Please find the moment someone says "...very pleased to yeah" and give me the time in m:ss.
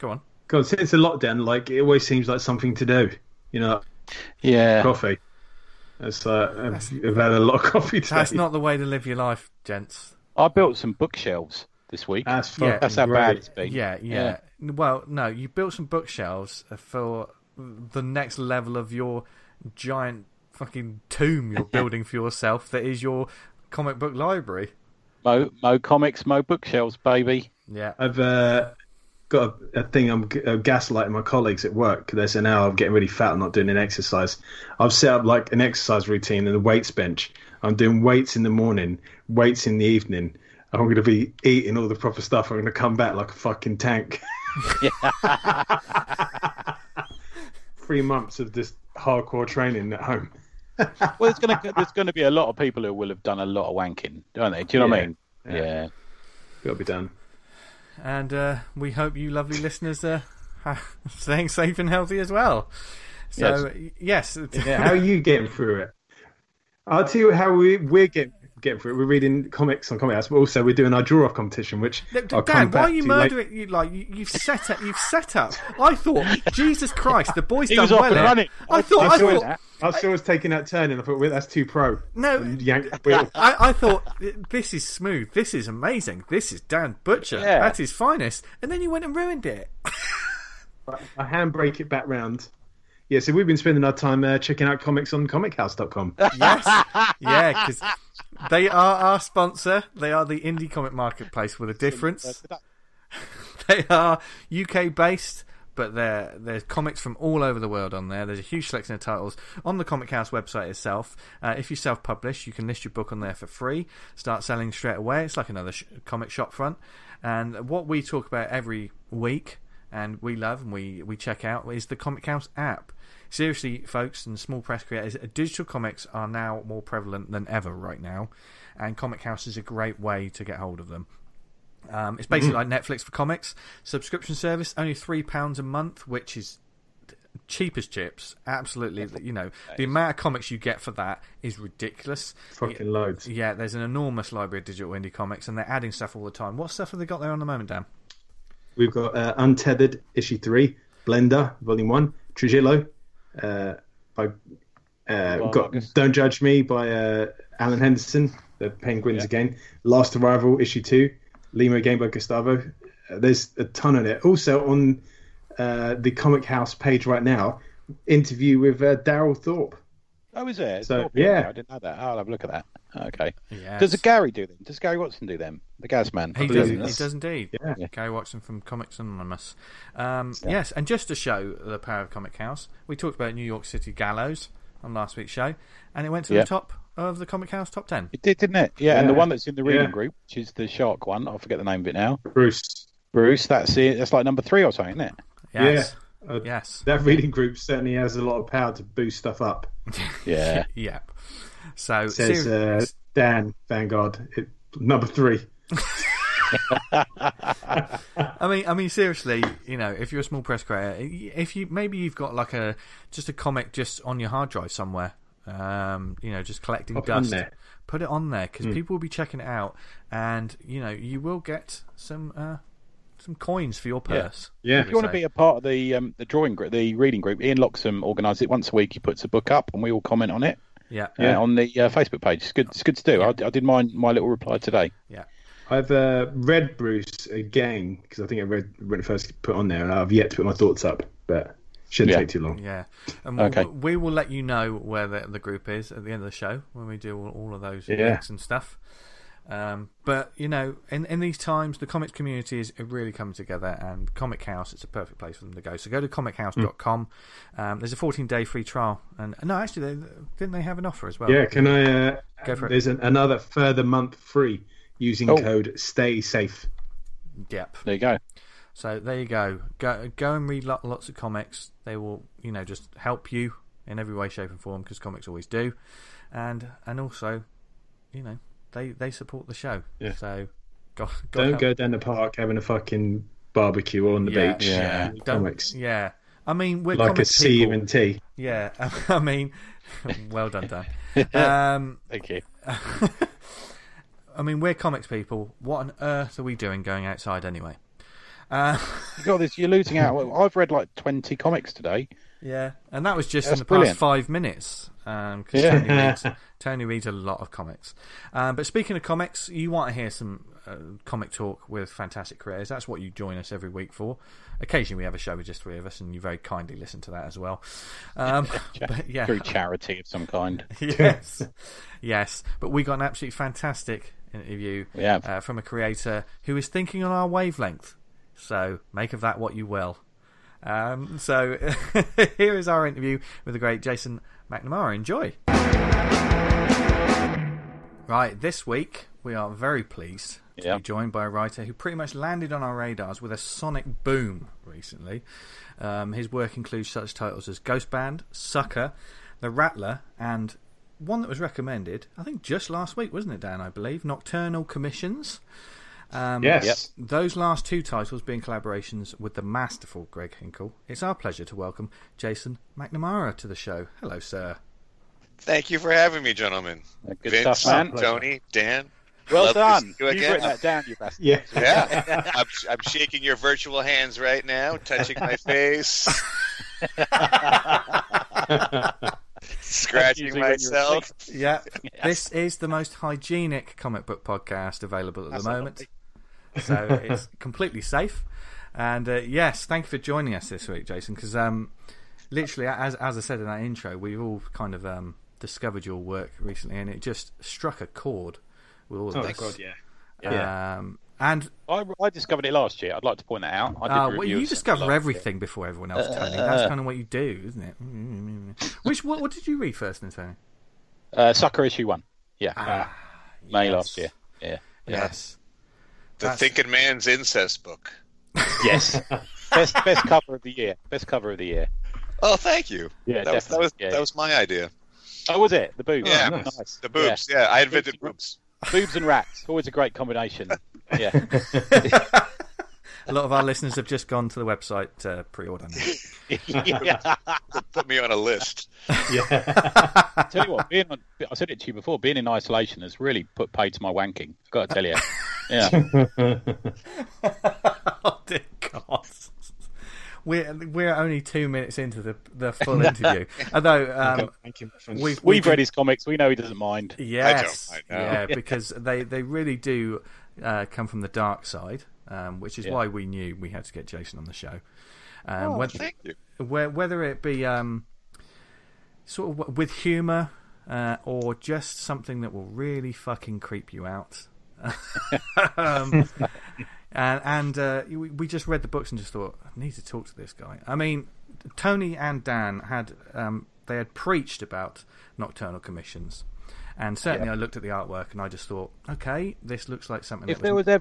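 5:39.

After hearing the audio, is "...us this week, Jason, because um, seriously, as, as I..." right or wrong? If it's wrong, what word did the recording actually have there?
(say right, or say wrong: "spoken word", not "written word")
wrong: "literally", not "seriously".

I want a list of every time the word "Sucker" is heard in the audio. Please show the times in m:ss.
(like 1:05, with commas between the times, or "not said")
5:48, 6:51.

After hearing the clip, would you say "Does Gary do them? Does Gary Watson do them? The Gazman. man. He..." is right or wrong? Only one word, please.
right.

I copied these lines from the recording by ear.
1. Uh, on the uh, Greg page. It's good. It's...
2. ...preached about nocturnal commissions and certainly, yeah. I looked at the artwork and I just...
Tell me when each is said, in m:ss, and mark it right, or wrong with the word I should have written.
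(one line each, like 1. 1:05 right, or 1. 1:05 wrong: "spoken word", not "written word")
1. 3:51 wrong: "Facebook", not "Greg"
2. 8:03 right.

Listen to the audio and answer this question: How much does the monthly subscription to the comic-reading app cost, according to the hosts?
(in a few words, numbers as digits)
£3.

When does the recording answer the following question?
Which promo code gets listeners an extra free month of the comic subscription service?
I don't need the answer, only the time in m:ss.
4:25.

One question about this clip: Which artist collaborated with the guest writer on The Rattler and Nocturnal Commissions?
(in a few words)
Greg Hinkle.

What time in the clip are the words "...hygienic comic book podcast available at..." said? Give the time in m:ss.
6:22.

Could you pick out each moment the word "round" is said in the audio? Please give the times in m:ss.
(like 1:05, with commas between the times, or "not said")
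1:32.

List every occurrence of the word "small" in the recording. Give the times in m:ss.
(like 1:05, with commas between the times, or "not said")
2:04, 3:30.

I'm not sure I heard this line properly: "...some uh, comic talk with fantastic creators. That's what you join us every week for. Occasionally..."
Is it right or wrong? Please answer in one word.
right.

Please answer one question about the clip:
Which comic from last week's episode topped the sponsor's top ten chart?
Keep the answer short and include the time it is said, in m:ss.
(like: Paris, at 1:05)
New York City Gallows, at 3:03.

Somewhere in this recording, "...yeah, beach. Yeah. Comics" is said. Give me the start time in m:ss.
4:44.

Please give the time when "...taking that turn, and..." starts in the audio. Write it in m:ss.
1:20.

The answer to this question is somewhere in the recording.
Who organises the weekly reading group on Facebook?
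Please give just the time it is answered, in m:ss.
3:47.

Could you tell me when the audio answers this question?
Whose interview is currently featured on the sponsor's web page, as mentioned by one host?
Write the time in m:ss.
2:48.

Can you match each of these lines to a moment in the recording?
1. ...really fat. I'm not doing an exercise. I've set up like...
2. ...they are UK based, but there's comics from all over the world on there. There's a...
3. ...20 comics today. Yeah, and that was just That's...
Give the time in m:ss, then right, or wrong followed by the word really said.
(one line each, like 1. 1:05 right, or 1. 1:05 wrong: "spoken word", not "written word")
1. 0:32 right
2. 1:43 right
3. 5:00 right.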